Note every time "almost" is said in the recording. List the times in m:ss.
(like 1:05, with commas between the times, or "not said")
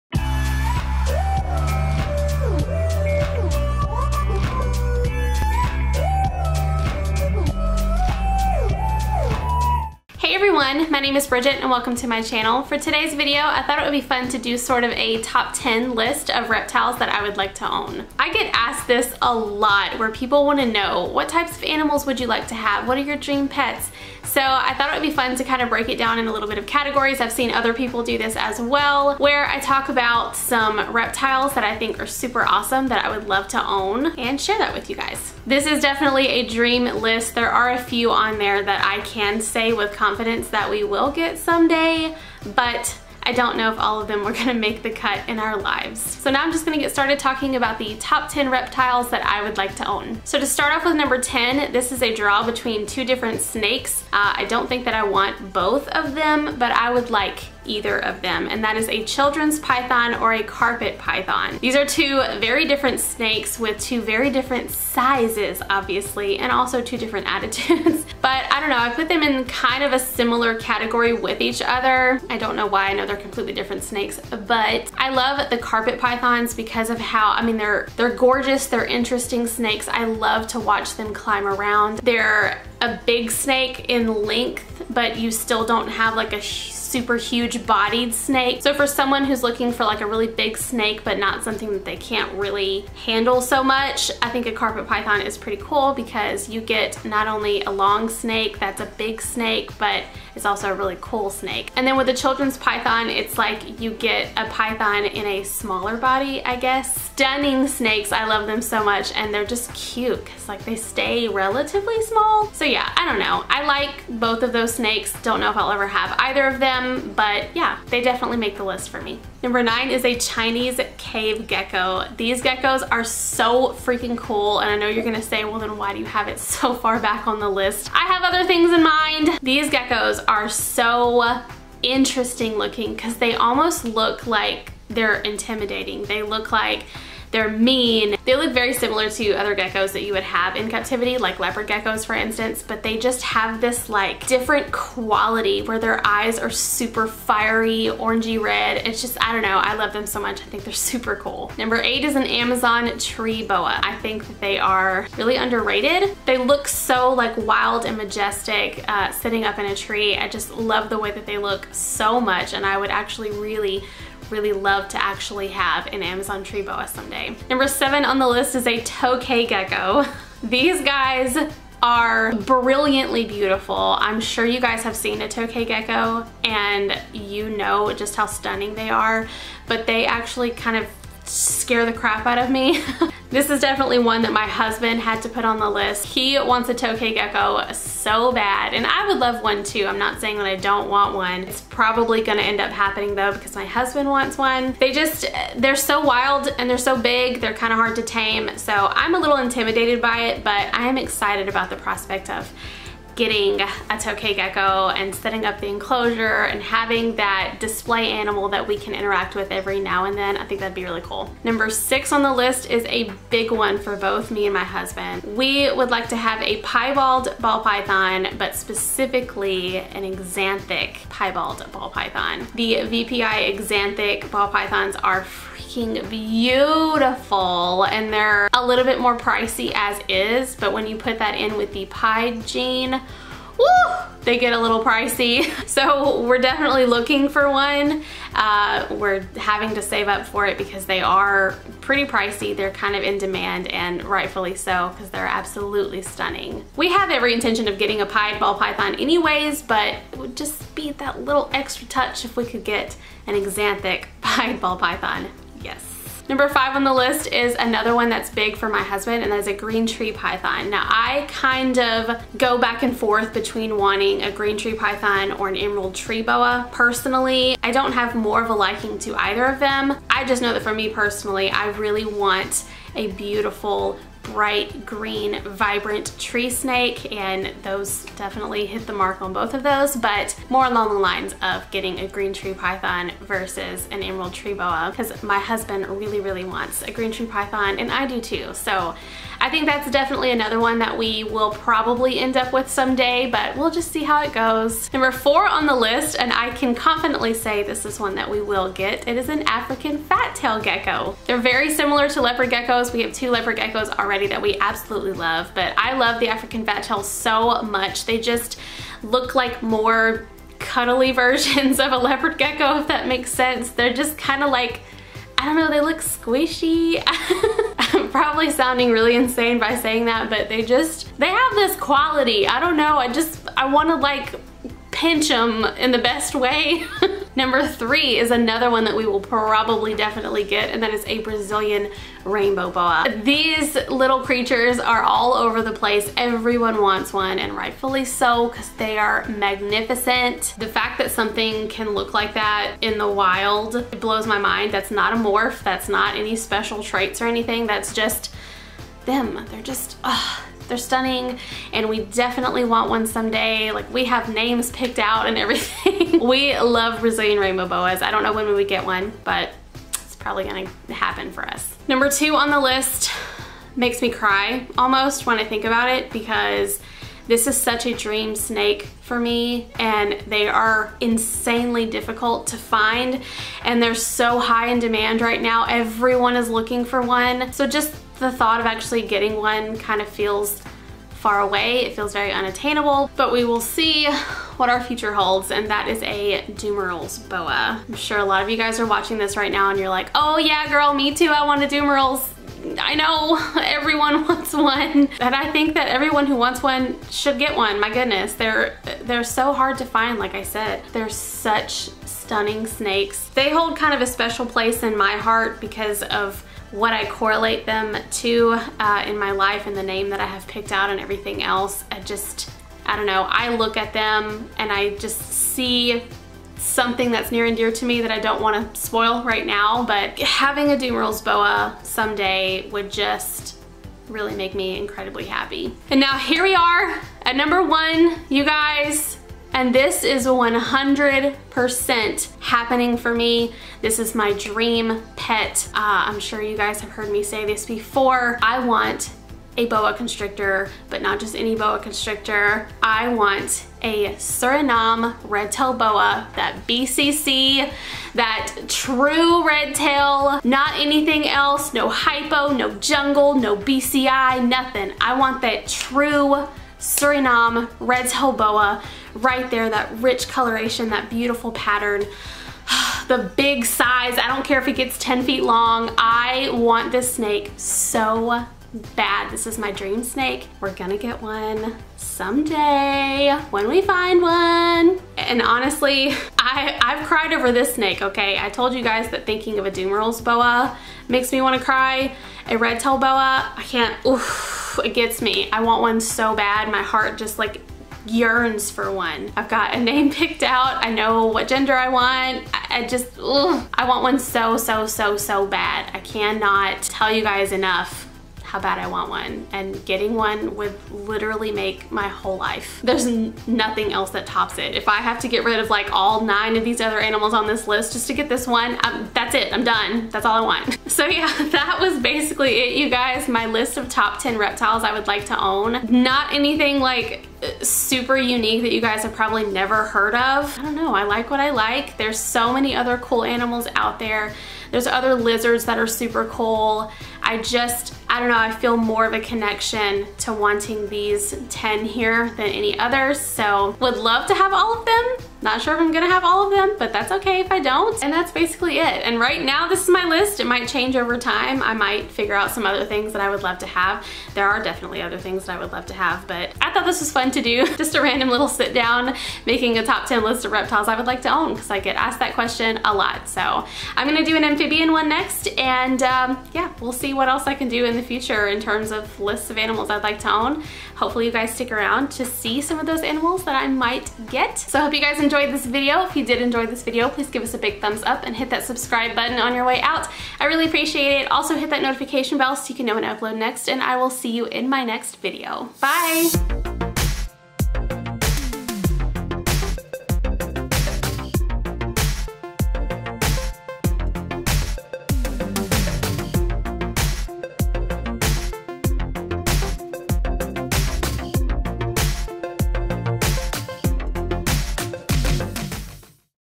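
2:13, 6:04.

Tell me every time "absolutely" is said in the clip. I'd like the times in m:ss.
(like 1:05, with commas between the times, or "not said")
4:05, 5:04.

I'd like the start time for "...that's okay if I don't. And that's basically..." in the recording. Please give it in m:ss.
8:56.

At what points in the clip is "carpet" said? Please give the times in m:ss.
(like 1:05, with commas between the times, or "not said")
1:00, 1:15, 1:34.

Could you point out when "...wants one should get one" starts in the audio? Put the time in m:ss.
6:36.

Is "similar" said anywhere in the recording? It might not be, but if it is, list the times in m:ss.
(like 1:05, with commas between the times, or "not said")
1:09, 2:18, 5:01.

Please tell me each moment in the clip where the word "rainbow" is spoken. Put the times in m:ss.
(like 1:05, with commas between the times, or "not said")
5:32, 5:57.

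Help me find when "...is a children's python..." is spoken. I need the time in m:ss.
0:58.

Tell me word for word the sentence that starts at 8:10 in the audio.
I know what gender I want.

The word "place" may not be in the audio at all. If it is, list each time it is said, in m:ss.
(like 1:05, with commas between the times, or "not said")
5:35, 6:44.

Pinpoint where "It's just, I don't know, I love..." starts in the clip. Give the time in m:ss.
2:28.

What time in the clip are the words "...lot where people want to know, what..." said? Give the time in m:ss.
0:19.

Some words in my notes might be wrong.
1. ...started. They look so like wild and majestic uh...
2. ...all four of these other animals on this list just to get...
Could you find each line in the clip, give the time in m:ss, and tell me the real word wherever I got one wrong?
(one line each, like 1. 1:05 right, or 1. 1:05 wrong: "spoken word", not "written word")
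1. 2:35 wrong: "underrated", not "started"
2. 8:25 wrong: "nine", not "four".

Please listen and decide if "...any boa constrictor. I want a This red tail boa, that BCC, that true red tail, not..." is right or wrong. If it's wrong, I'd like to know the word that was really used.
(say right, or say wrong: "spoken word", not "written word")
wrong: "Suriname", not "This".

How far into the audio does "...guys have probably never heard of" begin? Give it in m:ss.
8:38.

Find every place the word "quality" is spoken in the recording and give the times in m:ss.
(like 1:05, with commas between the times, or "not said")
2:24, 5:21.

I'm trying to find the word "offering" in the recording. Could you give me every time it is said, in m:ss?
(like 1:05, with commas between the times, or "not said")
not said.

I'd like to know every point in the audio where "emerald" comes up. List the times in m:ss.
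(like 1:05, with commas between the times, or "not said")
4:25, 4:44.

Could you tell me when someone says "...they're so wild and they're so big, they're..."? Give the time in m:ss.
3:15.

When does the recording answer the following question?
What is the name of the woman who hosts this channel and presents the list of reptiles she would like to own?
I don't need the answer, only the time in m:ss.
0:11.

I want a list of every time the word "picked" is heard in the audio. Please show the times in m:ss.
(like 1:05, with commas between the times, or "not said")
5:54, 6:50, 8:10.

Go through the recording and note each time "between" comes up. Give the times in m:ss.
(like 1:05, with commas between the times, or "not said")
0:52, 4:23.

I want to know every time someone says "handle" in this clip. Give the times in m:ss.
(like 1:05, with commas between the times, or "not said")
1:33.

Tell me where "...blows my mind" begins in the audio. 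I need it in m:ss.
5:44.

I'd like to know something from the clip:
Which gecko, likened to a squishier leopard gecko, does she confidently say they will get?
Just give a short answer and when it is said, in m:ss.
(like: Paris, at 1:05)
African fat tail gecko, at 4:59.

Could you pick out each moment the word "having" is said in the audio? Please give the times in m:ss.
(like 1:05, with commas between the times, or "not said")
3:26, 3:59, 7:00.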